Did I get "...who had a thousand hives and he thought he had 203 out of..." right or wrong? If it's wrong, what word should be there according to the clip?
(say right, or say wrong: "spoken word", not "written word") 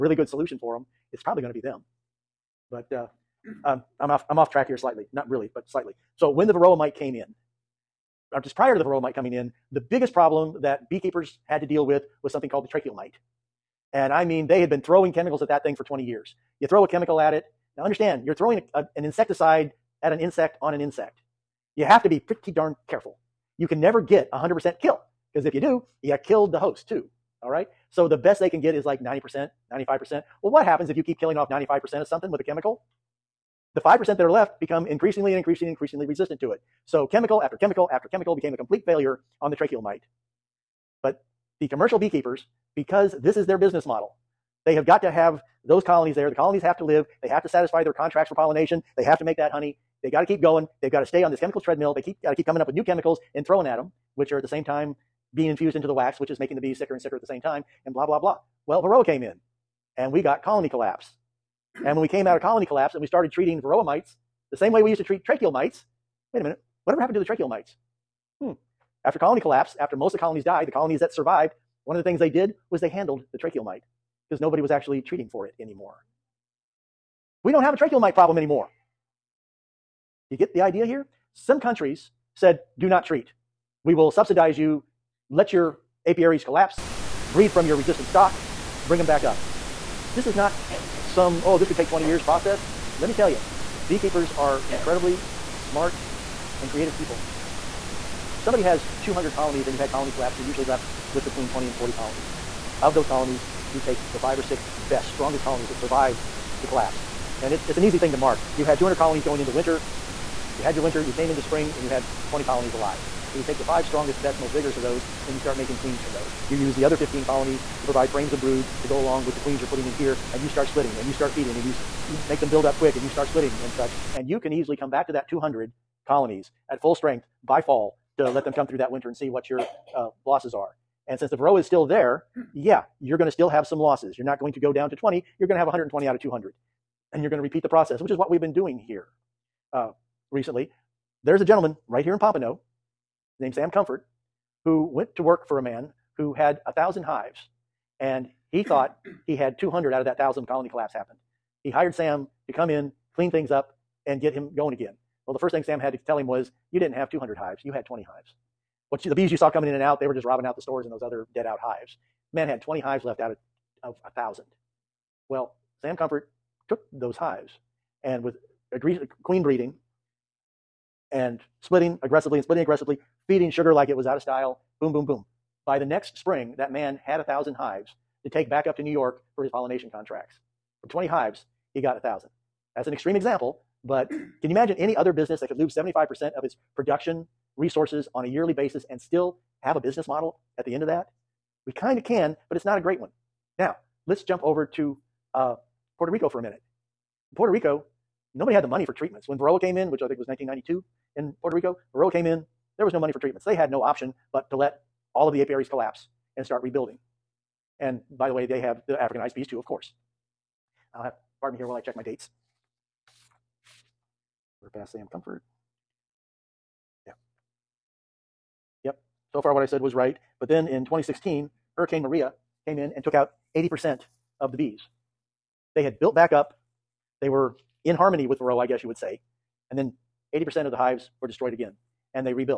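wrong: "200", not "203".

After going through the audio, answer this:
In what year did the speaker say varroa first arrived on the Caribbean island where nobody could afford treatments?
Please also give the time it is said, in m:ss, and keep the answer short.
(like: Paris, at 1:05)
1992, at 3:20.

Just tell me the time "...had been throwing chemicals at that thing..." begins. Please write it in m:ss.
0:14.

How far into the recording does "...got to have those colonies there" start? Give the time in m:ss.
0:44.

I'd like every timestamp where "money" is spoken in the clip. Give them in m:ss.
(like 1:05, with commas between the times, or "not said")
3:18, 3:22.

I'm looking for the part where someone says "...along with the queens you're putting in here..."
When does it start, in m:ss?
1:58.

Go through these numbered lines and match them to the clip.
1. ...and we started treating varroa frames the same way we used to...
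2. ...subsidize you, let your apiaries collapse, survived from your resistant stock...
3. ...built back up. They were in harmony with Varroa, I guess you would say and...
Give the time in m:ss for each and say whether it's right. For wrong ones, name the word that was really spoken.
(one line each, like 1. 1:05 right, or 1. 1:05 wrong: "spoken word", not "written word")
1. 1:02 wrong: "mites", not "frames"
2. 1:24 wrong: "breed", not "survived"
3. 3:45 right.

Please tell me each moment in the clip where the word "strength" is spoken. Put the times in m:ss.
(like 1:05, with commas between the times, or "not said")
2:06.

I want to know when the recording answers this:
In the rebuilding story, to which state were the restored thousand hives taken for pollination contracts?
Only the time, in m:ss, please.
2:58.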